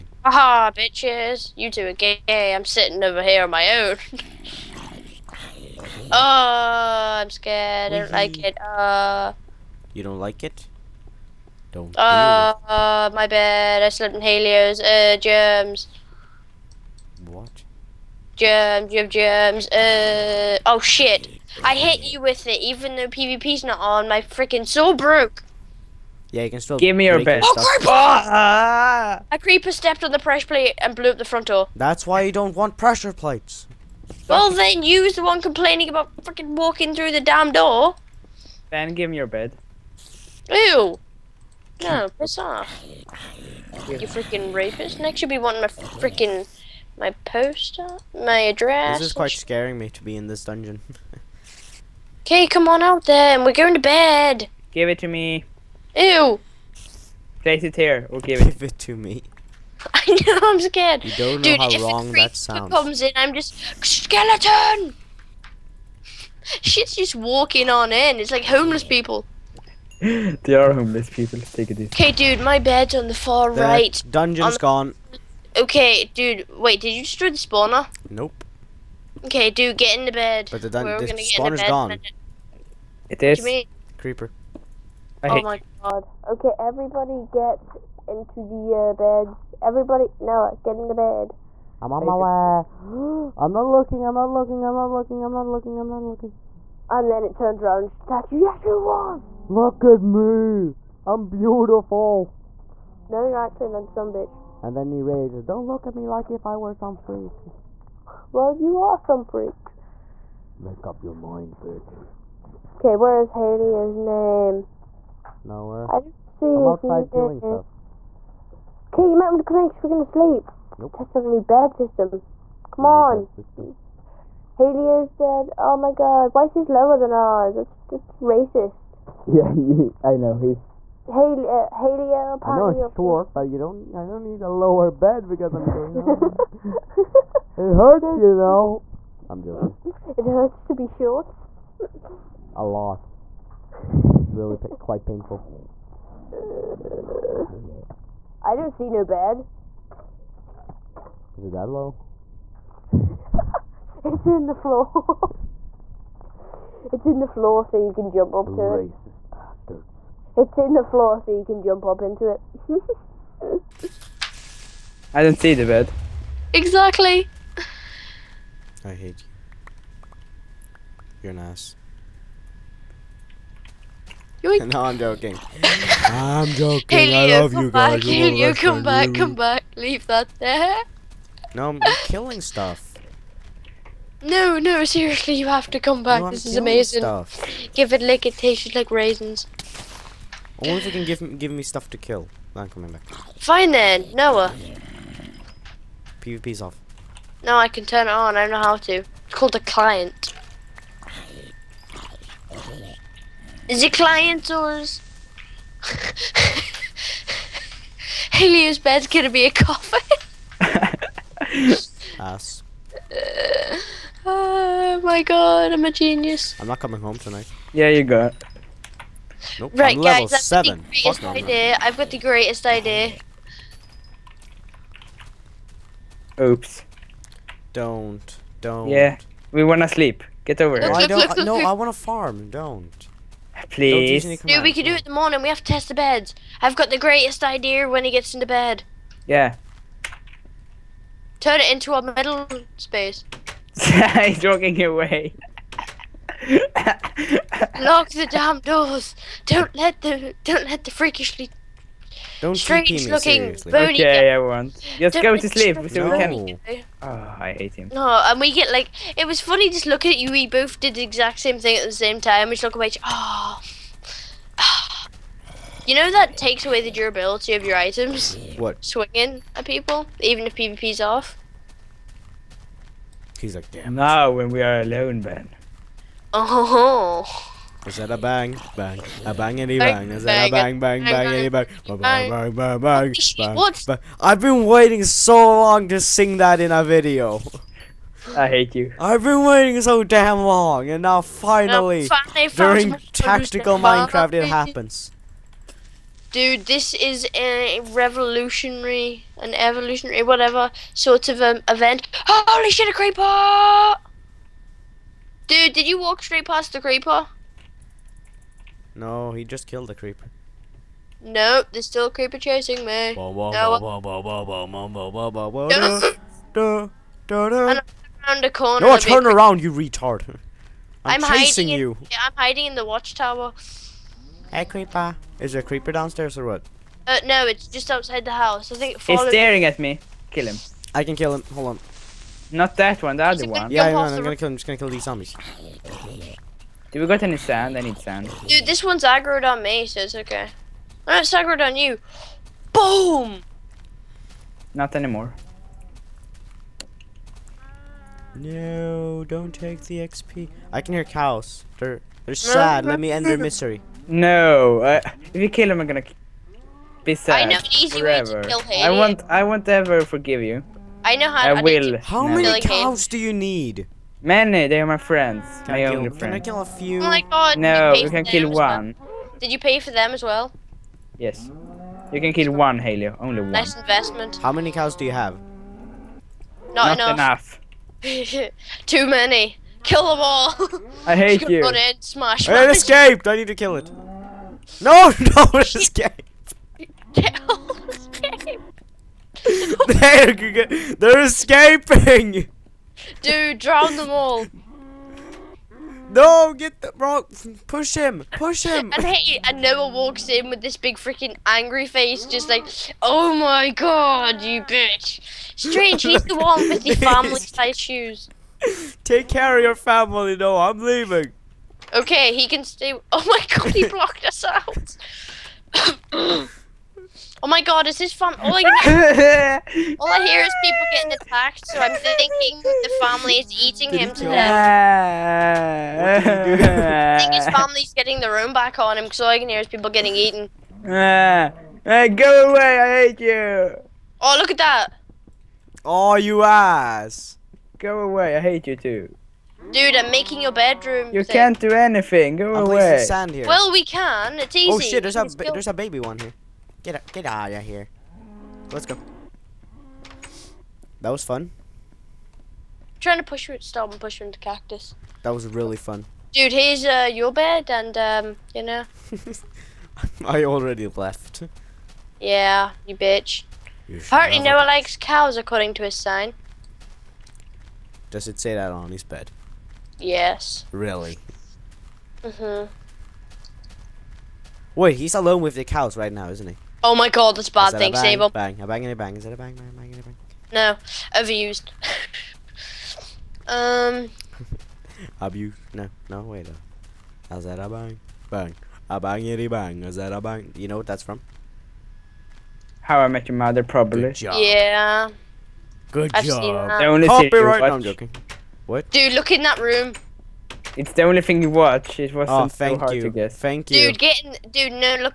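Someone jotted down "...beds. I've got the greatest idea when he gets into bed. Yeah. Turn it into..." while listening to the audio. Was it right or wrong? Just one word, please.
right.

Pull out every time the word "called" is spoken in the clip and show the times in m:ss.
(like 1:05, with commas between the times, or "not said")
3:19.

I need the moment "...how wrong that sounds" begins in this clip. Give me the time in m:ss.
1:01.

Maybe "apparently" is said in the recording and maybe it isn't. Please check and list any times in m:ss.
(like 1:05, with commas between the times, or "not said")
2:12, 7:43.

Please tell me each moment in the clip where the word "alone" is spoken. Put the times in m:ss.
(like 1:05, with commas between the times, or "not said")
4:34, 7:55.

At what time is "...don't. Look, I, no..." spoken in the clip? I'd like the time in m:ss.
3:51.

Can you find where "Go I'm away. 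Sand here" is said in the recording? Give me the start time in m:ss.
7:22.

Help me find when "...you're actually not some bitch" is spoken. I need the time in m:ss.
1:43.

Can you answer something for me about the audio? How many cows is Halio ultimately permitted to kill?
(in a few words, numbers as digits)
1.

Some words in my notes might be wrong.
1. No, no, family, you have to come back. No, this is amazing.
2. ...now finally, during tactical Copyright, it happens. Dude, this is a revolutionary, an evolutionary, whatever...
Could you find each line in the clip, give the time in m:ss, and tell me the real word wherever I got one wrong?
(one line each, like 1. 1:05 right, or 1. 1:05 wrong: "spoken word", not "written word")
1. 3:04 wrong: "seriously", not "family"
2. 4:51 wrong: "Minecraft", not "Copyright".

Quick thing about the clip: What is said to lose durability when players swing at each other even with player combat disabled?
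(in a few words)
Your items.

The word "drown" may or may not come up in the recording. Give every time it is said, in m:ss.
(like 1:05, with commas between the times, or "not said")
6:33.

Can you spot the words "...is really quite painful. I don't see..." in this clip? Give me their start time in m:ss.
2:24.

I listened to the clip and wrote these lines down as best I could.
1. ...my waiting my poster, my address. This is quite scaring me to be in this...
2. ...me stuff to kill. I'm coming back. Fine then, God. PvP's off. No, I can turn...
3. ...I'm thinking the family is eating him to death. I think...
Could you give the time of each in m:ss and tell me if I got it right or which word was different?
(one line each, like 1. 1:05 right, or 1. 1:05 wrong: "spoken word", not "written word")
1. 0:45 wrong: "freaking", not "waiting"
2. 3:11 wrong: "Noah", not "God"
3. 7:01 right.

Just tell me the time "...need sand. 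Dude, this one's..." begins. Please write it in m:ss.
5:37.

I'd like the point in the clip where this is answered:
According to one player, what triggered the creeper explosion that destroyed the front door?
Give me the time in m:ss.
0:30.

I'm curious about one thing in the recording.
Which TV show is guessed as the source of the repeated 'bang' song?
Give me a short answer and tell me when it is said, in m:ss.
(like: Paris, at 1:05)
How I Met Your Mother, at 8:12.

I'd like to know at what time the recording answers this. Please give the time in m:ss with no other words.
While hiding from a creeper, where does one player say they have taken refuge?
5:22.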